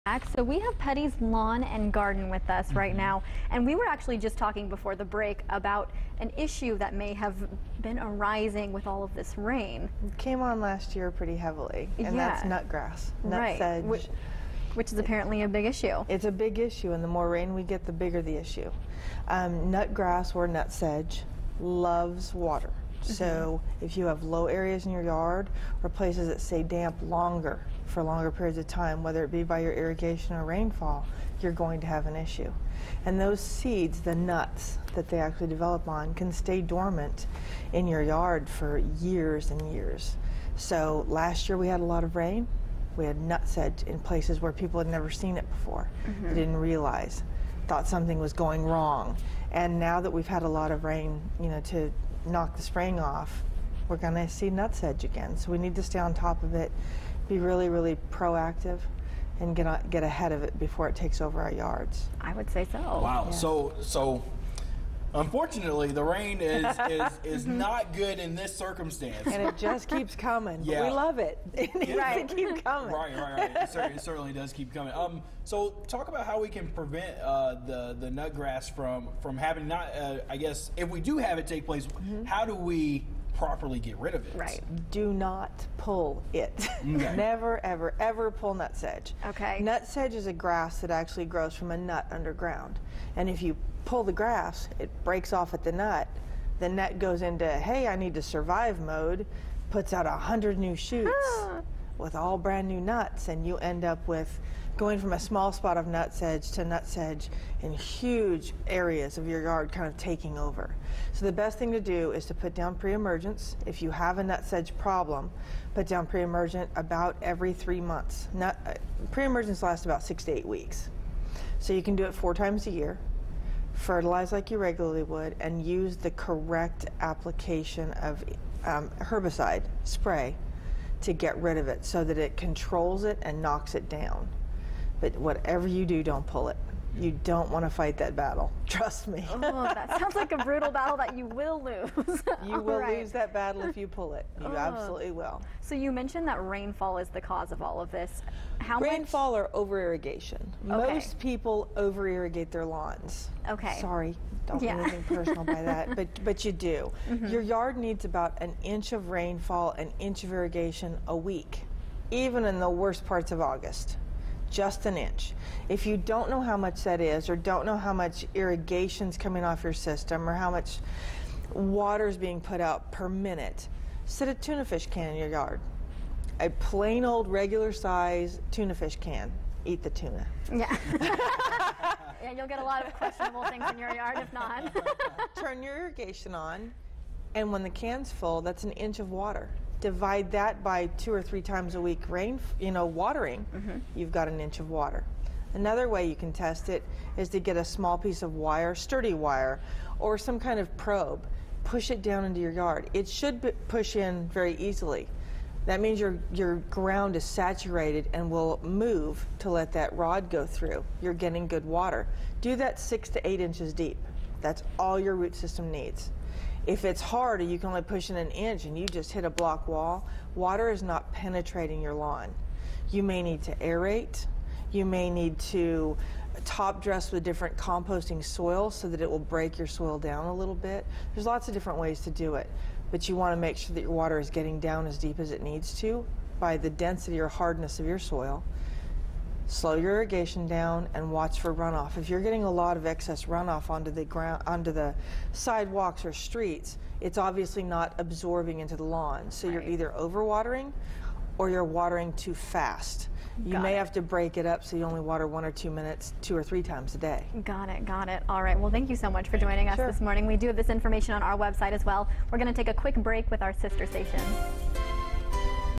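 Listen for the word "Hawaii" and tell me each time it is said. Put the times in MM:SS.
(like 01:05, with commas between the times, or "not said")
not said.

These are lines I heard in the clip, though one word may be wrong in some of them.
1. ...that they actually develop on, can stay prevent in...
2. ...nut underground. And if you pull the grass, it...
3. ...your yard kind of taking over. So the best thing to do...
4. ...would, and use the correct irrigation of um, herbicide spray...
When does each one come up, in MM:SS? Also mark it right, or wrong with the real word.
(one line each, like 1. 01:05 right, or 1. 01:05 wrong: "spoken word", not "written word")
1. 00:34 wrong: "dormant", not "prevent"
2. 01:31 right
3. 01:49 right
4. 02:05 wrong: "application", not "irrigation".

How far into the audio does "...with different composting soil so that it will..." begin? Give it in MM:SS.
03:47.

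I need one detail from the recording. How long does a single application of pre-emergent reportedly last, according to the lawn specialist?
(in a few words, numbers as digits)
6 to 8 weeks.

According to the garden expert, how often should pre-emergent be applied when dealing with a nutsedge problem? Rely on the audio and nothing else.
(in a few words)
Every three months.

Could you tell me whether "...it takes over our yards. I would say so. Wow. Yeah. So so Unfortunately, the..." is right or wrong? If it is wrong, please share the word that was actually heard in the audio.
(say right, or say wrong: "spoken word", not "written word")
right.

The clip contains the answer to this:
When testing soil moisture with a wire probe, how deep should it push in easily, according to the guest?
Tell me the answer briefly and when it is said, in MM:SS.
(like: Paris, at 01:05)
6 to 8 inches, at 03:32.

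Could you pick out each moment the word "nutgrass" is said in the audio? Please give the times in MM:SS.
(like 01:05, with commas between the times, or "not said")
00:12, 00:19.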